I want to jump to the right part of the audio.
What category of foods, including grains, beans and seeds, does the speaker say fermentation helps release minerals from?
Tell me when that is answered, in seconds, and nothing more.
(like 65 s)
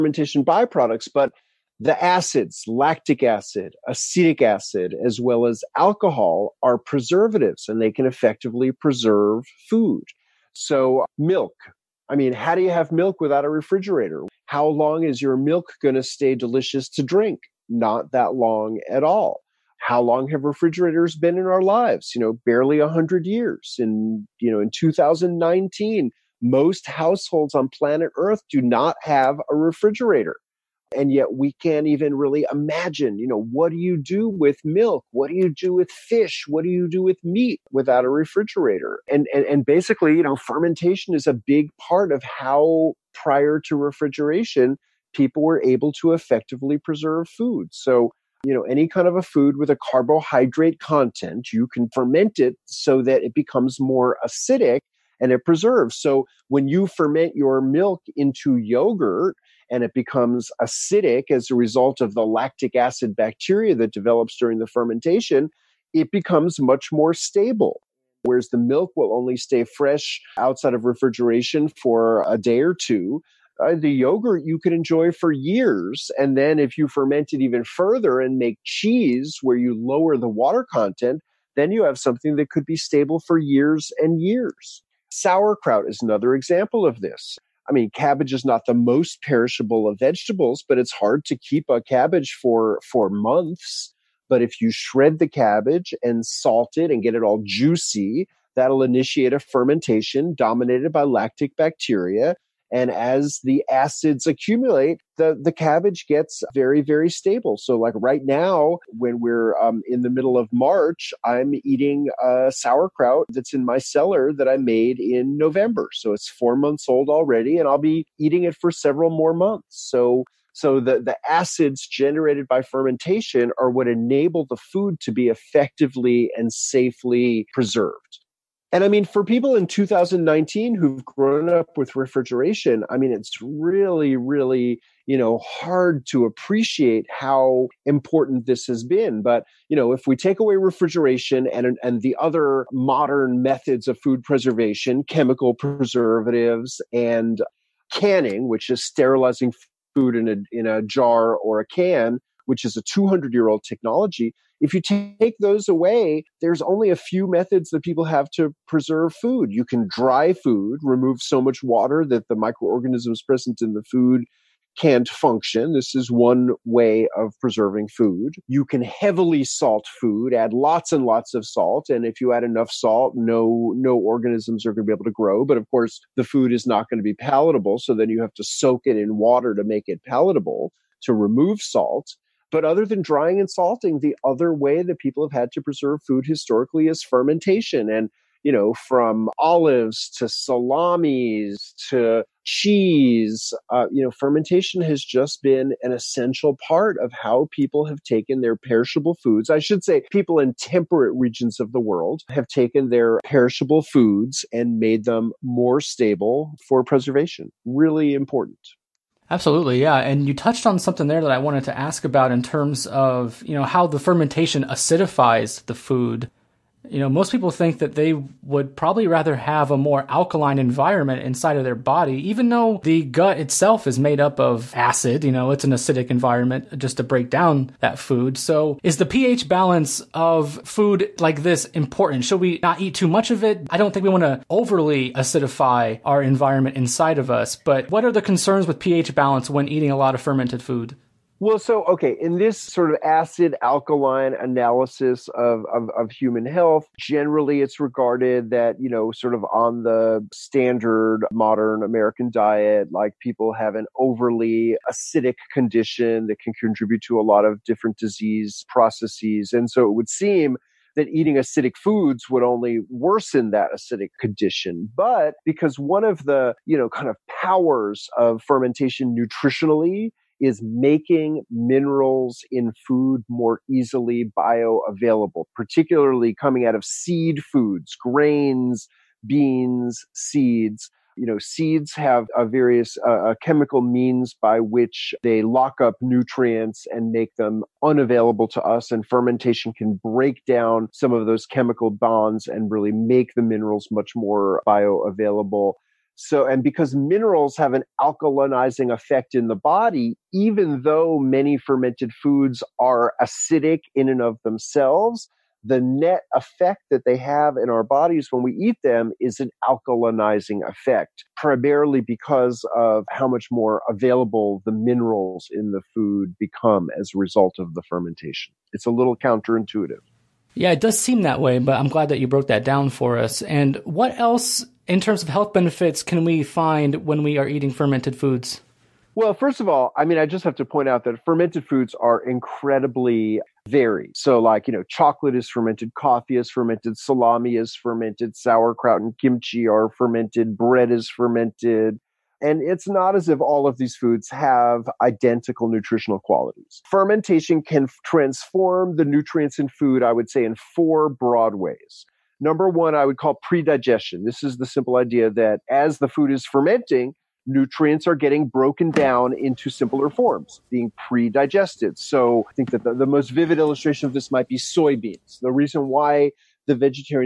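276 s.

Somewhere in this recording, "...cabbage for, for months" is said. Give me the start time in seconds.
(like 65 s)
91 s.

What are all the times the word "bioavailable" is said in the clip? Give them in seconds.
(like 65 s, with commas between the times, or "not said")
274 s, 294 s.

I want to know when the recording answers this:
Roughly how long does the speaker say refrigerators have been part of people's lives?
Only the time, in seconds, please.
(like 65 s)
22 s.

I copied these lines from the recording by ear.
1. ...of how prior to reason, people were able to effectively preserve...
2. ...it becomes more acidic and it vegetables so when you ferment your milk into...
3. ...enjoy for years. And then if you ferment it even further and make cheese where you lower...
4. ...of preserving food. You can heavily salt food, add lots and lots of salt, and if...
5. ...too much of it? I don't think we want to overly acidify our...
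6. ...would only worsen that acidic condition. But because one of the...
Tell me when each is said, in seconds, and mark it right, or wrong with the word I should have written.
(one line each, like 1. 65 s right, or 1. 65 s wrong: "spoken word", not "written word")
1. 42 s wrong: "refrigeration", not "reason"
2. 53 s wrong: "preserves", not "vegetables"
3. 74 s right
4. 167 s right
5. 232 s right
6. 262 s right.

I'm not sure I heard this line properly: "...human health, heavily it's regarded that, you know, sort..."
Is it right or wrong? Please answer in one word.
wrong.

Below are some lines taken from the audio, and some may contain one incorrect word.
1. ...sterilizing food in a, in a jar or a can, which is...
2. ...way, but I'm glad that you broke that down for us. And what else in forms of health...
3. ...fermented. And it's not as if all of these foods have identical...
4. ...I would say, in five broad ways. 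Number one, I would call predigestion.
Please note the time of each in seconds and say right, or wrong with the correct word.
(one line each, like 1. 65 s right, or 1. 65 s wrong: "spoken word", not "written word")
1. 148 s right
2. 321 s wrong: "terms", not "forms"
3. 341 s right
4. 350 s wrong: "four", not "five".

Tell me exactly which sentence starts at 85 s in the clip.
Sauerkraut is another example of this.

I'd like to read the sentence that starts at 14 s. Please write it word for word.
How long is your milk going to stay delicious to drink?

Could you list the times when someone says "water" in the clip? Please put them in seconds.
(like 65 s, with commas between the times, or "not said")
80 s, 161 s, 179 s.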